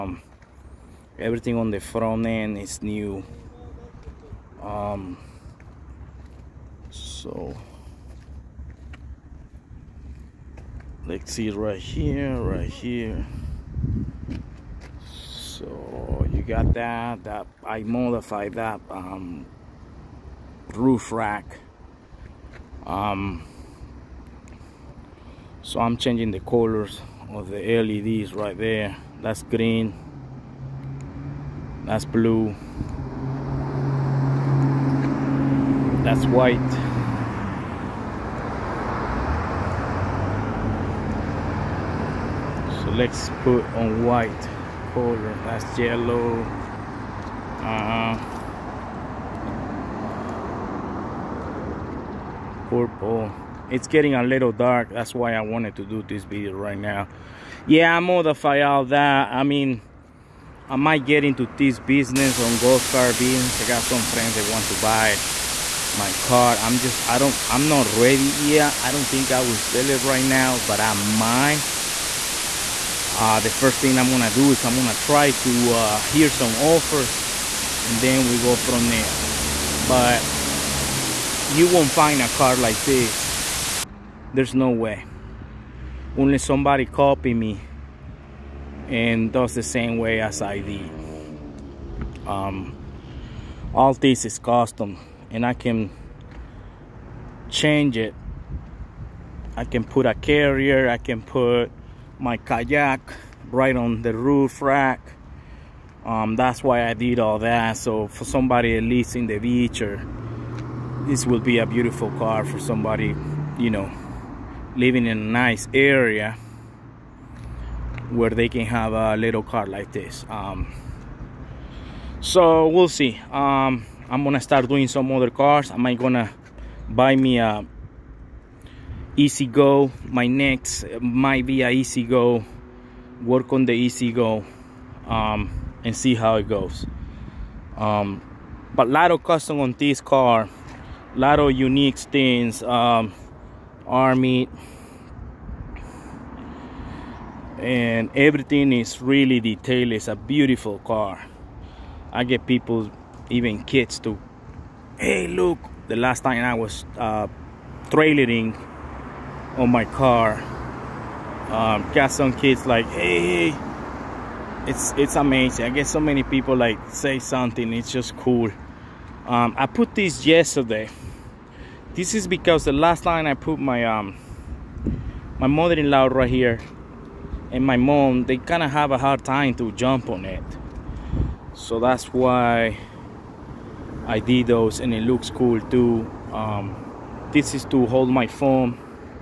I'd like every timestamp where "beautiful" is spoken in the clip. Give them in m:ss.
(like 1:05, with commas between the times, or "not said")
1:51, 2:30.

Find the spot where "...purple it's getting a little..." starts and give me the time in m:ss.
0:52.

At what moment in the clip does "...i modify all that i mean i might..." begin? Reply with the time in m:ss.
0:57.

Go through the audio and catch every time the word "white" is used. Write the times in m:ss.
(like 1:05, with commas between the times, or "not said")
0:36, 0:44.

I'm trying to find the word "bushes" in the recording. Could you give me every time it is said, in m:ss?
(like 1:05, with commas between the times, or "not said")
not said.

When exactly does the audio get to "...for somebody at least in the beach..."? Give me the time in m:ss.
1:48.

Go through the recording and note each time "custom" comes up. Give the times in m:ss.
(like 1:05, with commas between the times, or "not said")
1:34, 2:19.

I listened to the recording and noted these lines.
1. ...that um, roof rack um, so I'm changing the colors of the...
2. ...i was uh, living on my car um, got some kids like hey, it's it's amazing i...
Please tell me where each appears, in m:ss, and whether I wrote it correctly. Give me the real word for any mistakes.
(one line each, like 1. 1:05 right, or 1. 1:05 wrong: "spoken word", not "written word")
1. 0:18 right
2. 2:36 wrong: "trailering", not "living".